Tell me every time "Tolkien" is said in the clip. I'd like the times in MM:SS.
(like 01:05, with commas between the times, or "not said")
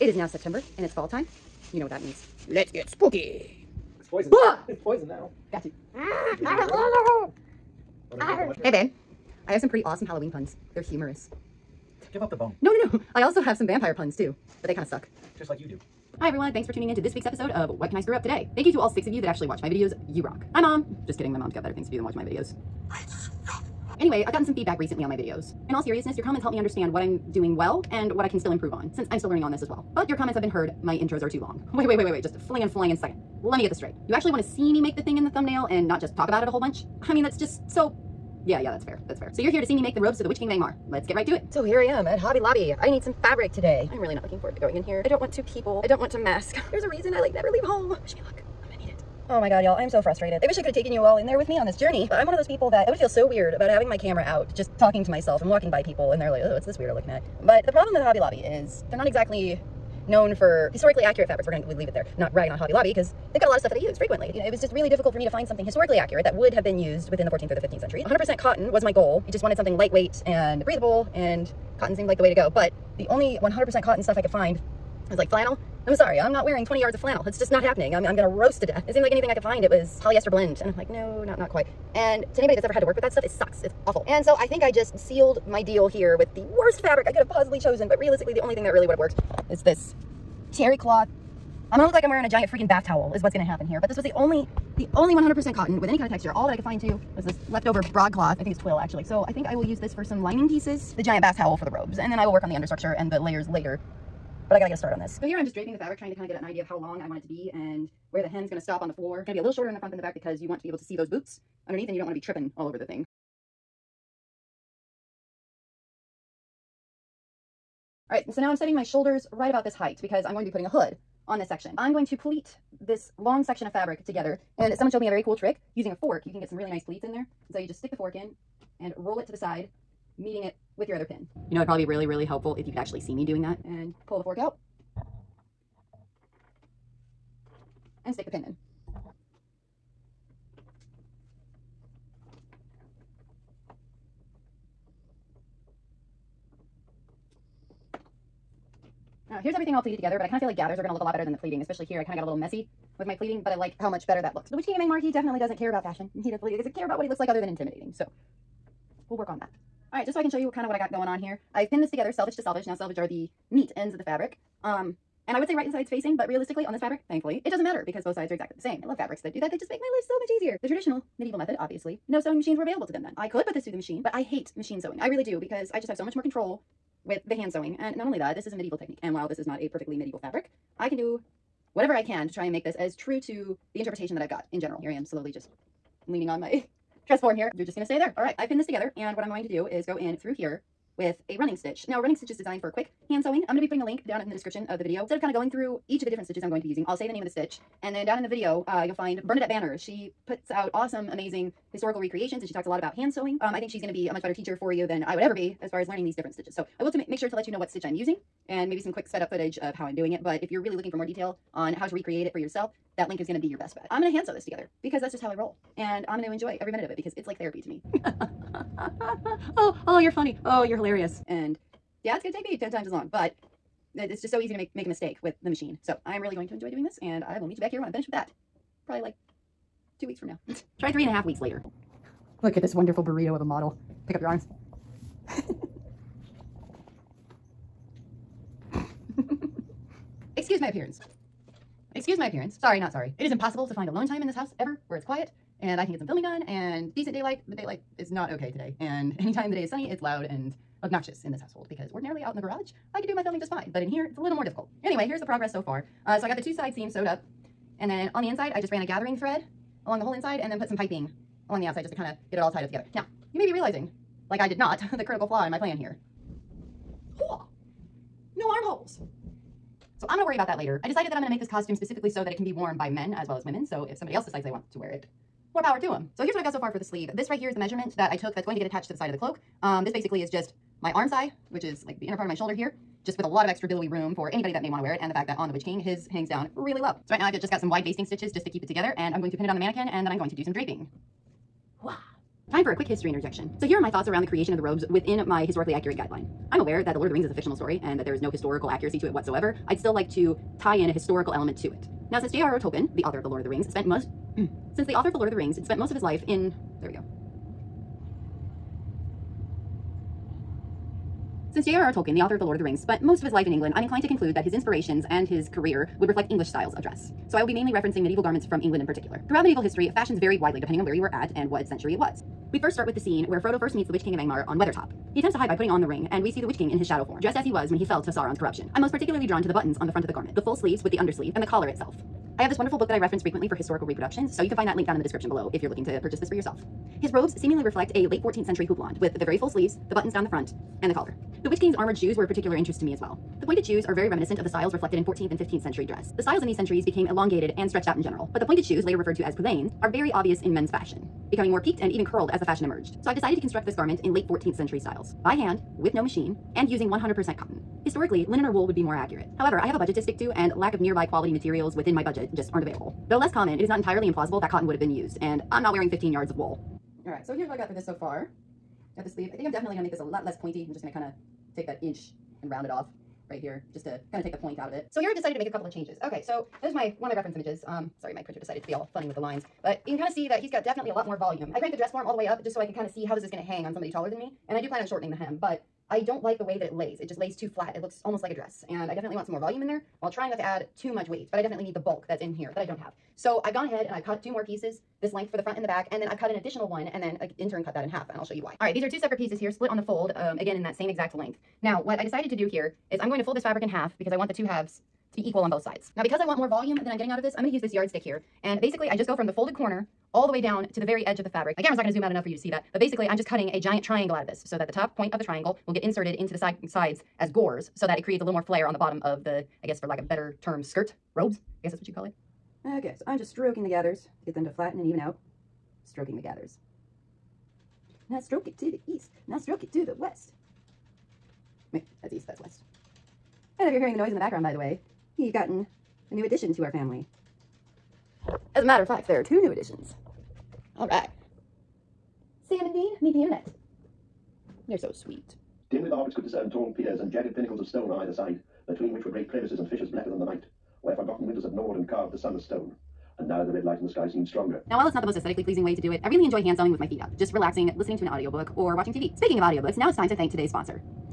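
05:02, 05:11.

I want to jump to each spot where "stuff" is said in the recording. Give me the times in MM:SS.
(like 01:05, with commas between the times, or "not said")
01:03, 01:14, 01:23.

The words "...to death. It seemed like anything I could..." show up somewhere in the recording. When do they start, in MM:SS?
01:18.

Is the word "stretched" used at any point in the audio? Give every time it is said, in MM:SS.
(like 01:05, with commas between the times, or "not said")
05:47.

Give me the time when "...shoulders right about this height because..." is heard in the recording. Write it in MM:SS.
01:58.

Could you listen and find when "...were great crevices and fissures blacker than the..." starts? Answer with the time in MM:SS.
07:29.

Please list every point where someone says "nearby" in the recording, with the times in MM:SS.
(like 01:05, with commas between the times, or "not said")
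06:00.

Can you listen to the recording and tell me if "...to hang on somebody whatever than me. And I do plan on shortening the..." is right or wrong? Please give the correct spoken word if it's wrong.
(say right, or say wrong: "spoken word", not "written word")
wrong: "taller", not "whatever".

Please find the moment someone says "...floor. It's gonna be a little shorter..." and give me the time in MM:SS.
01:48.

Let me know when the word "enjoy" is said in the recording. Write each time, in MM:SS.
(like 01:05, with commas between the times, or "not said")
03:36, 03:46, 07:36.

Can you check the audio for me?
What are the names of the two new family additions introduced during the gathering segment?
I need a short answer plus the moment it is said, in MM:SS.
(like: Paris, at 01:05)
Sam and Dean, at 07:22.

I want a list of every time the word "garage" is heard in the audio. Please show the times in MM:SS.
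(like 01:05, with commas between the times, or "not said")
04:12.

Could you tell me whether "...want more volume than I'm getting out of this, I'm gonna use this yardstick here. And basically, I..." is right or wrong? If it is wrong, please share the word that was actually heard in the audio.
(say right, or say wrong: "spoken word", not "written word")
right.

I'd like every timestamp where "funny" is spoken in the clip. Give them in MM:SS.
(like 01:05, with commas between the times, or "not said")
03:40, 06:18.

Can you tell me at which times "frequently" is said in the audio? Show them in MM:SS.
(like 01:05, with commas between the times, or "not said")
01:03, 05:33.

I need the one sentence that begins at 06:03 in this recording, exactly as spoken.
Though less common, it is not entirely implausible that cotton would have been used, and I'm not wearing 15 yards of wool.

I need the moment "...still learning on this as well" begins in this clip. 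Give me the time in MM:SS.
00:29.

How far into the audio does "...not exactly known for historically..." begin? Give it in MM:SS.
00:58.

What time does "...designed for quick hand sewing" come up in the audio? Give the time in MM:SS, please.
03:12.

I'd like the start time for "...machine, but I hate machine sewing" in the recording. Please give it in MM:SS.
02:53.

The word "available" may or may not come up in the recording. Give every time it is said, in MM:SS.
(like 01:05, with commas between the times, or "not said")
02:52, 06:02.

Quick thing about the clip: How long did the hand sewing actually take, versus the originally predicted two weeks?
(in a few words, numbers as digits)
3.5 weeks.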